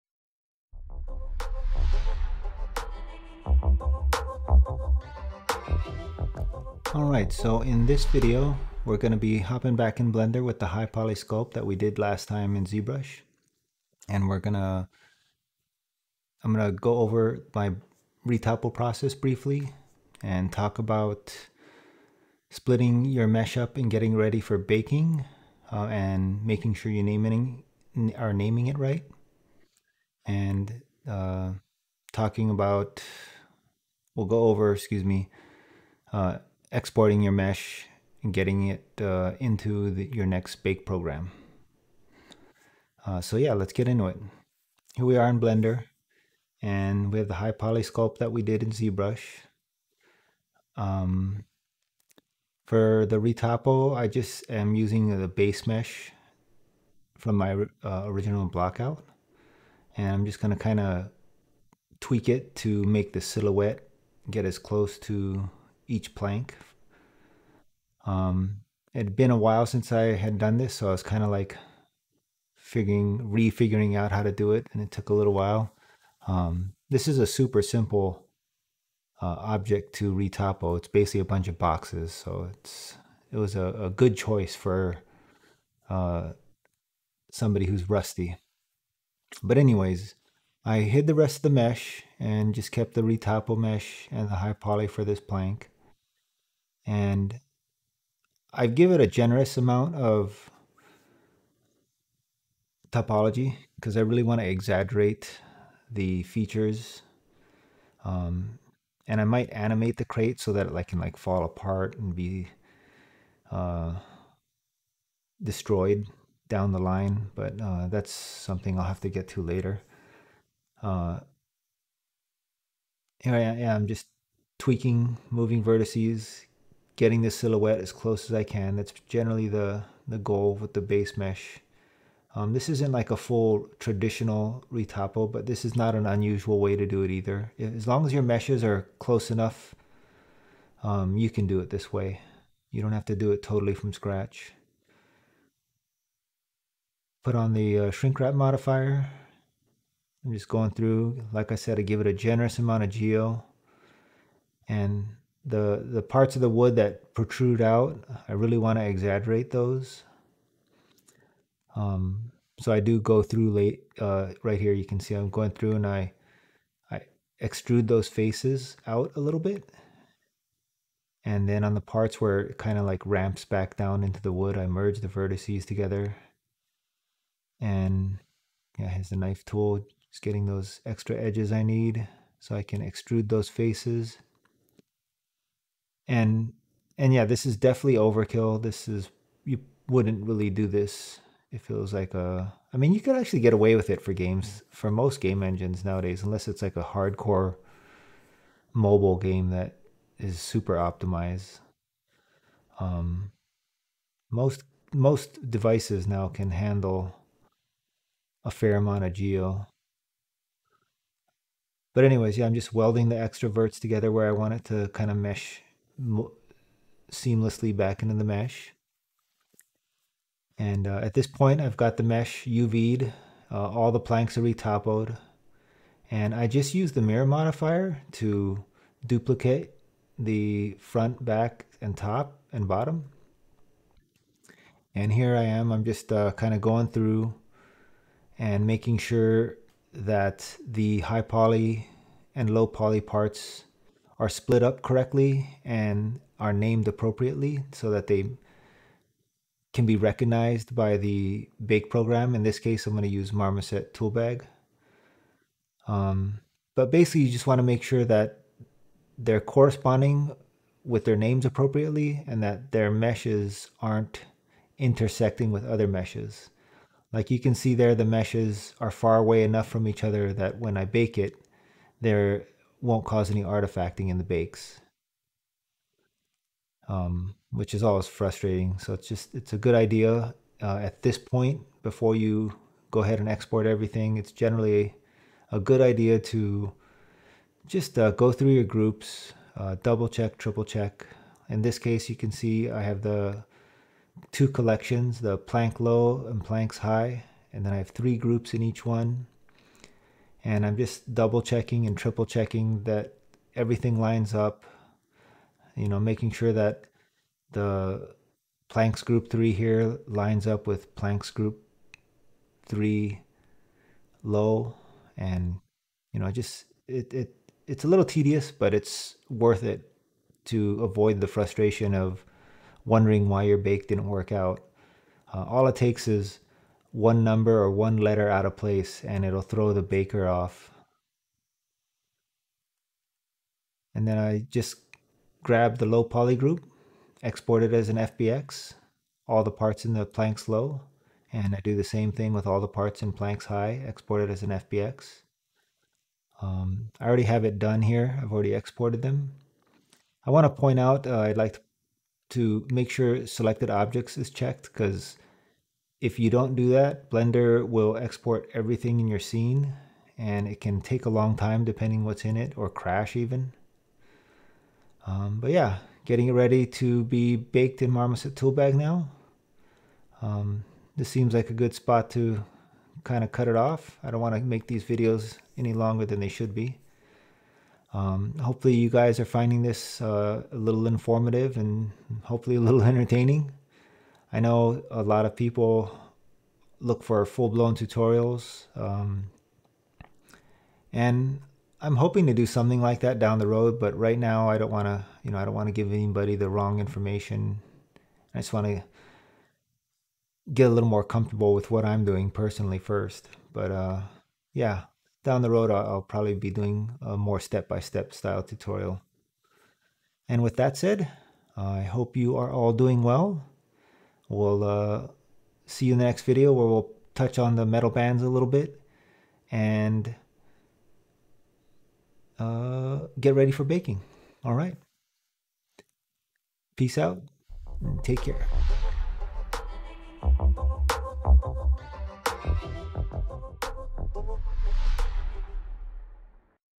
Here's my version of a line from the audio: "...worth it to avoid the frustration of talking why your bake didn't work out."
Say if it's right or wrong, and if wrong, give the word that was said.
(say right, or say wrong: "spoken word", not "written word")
wrong: "wondering", not "talking".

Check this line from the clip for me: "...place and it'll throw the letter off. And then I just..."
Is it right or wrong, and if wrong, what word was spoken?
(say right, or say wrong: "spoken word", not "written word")
wrong: "baker", not "letter".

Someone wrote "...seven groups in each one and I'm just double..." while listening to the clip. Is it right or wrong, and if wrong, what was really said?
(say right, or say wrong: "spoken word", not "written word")
wrong: "three", not "seven".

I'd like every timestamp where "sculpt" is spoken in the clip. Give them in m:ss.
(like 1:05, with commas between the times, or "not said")
0:11, 0:47.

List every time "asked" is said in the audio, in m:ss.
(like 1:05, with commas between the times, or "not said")
not said.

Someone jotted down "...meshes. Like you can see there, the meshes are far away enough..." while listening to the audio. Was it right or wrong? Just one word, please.
right.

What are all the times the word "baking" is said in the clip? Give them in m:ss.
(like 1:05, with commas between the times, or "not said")
0:24, 7:03.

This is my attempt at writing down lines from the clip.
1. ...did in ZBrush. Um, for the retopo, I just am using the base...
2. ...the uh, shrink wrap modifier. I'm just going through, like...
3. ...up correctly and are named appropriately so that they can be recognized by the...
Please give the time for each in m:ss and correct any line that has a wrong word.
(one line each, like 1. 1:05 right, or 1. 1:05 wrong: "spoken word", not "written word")
1. 0:48 right
2. 2:27 right
3. 4:04 right.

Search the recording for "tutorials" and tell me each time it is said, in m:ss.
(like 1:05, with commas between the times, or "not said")
6:27, 6:48.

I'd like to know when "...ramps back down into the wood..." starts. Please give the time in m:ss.
2:53.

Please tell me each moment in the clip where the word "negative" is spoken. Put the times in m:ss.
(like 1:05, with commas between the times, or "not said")
not said.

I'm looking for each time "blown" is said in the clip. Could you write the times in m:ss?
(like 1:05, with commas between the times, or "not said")
6:27.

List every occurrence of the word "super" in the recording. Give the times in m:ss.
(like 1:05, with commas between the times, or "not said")
1:17, 3:20.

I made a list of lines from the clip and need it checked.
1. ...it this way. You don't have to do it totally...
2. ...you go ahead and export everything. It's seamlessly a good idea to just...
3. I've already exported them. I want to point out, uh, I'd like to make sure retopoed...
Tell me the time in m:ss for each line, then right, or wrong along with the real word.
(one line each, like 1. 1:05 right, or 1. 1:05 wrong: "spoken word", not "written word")
1. 2:21 right
2. 4:42 wrong: "generally", not "seamlessly"
3. 5:48 wrong: "selected", not "retopoed".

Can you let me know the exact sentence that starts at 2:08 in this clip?
That's generally the, the goal with the base mesh.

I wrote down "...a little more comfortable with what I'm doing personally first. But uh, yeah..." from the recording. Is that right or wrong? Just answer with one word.
right.